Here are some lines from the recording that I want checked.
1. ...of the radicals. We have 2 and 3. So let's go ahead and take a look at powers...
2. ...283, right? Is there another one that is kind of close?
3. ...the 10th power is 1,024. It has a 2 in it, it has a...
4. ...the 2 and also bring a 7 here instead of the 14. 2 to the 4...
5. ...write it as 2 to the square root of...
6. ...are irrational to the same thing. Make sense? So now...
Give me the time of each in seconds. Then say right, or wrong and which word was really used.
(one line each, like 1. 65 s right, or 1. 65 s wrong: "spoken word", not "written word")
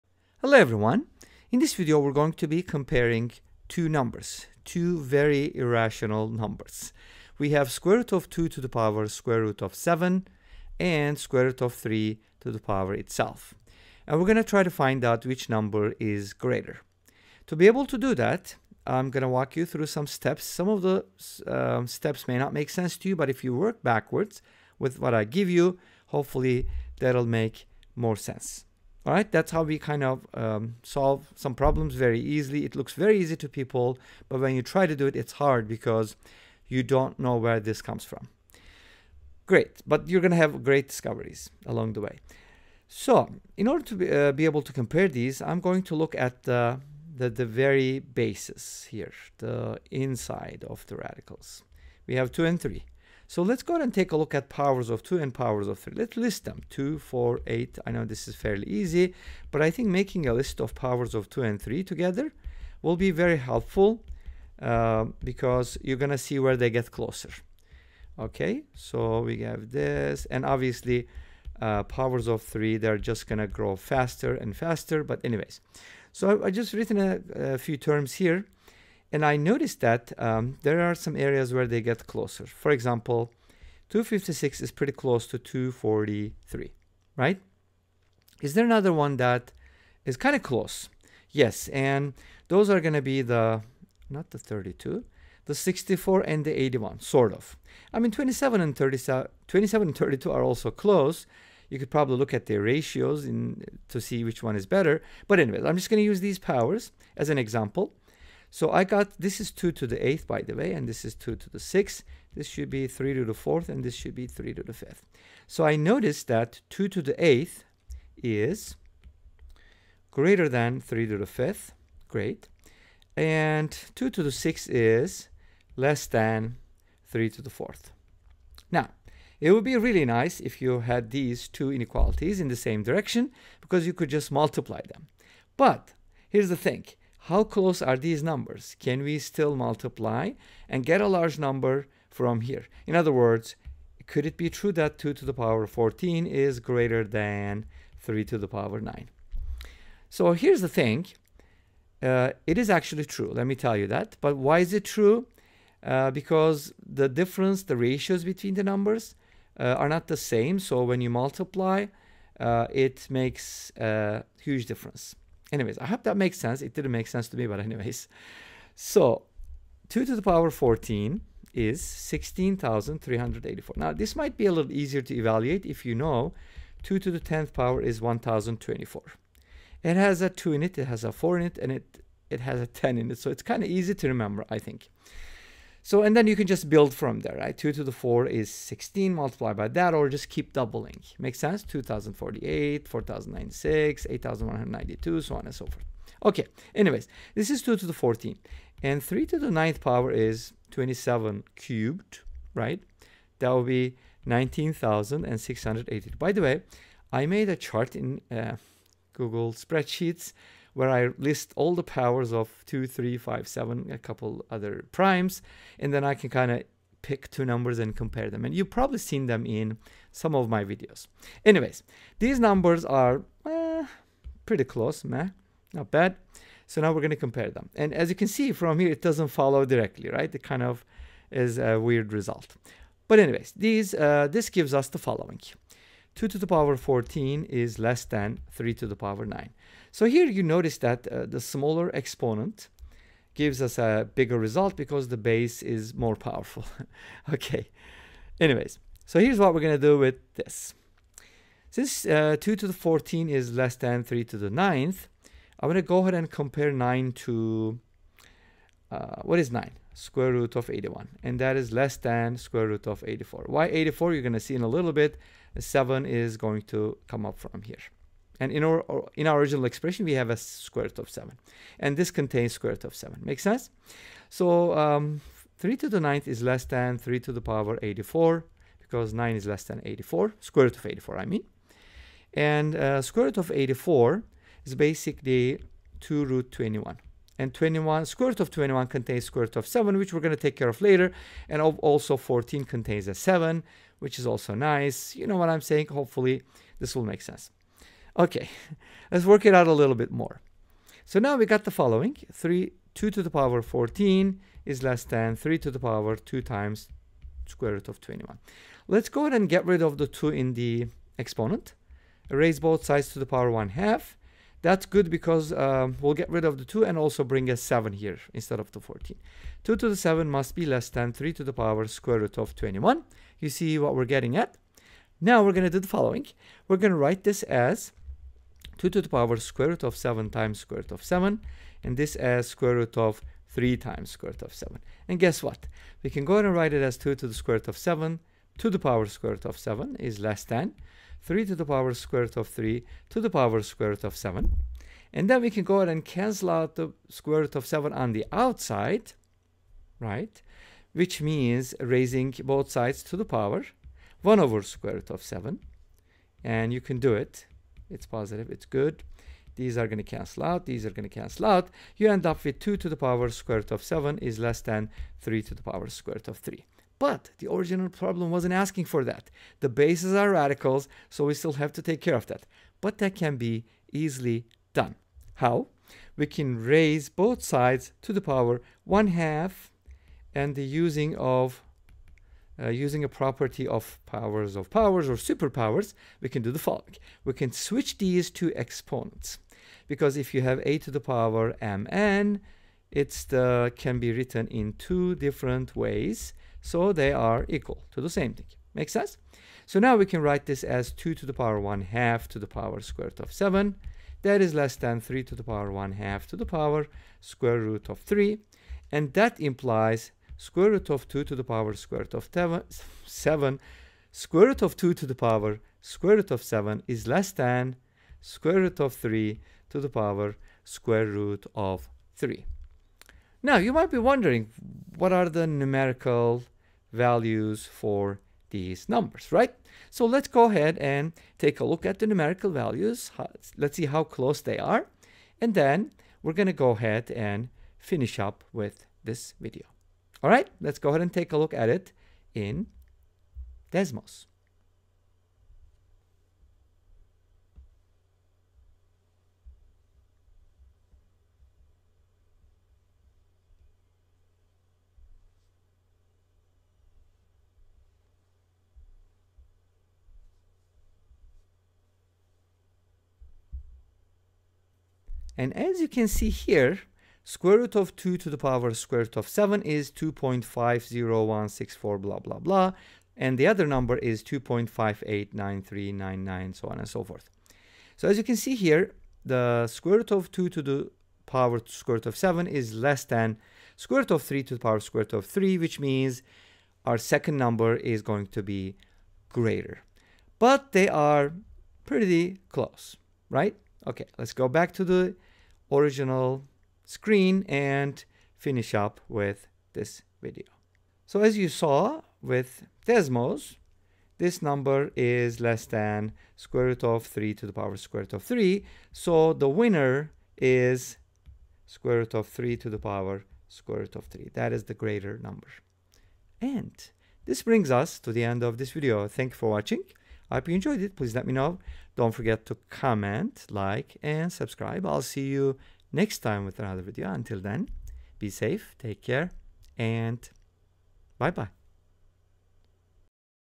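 1. 50 s right
2. 85 s wrong: "243", not "283"
3. 177 s right
4. 316 s wrong: "7", not "4"
5. 336 s right
6. 397 s wrong: "equal", not "irrational".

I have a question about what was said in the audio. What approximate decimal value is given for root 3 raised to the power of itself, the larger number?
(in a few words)
2.589399.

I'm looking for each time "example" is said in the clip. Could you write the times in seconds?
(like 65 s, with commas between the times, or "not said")
82 s, 107 s.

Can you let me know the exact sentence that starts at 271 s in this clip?
And this contains square root of 7.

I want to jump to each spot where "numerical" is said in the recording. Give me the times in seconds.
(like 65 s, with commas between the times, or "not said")
425 s, 432 s.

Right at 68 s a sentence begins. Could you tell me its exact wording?
Okay, so we have this, and obviously uh, powers of 3, they're just going to grow faster and faster, but anyways.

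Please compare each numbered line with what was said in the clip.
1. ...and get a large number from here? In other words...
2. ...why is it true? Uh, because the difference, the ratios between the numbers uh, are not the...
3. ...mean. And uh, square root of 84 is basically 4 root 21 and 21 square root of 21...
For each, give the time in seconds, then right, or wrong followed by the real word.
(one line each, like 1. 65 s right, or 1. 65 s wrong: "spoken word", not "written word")
1. 140 s right
2. 154 s right
3. 281 s wrong: "2", not "4".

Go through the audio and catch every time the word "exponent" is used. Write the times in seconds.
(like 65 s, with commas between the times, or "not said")
241 s, 311 s, 388 s.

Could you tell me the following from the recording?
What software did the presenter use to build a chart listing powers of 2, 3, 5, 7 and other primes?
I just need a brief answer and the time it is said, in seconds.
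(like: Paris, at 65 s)
Google Spreadsheets, at 209 s.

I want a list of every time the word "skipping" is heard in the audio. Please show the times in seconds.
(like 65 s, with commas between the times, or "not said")
not said.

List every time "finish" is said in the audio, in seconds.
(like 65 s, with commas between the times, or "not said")
437 s, 498 s.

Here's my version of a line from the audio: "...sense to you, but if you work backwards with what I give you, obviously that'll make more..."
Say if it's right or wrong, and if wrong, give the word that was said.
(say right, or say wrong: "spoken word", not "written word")
wrong: "hopefully", not "obviously".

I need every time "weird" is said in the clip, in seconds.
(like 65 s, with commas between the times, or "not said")
231 s.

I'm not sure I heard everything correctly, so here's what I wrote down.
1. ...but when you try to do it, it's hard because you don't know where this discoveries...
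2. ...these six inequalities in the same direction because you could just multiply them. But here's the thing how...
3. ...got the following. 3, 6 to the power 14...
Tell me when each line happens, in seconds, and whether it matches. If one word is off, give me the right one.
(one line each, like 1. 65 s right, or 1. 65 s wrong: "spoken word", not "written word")
1. 34 s wrong: "comes", not "discoveries"
2. 131 s wrong: "two", not "six"
3. 301 s wrong: "2", not "6".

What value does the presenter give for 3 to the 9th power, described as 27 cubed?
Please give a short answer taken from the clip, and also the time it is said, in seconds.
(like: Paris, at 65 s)
19,680, at 204 s.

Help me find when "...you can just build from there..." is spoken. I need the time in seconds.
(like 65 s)
186 s.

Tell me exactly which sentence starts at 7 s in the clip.
We have square root of 2 to the power square root of 7 and square root of 3 to the power itself.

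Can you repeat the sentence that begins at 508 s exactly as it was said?
So the winner is square root of 3 to the power square root of 3.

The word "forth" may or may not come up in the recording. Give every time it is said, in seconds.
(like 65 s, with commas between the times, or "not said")
195 s, 477 s.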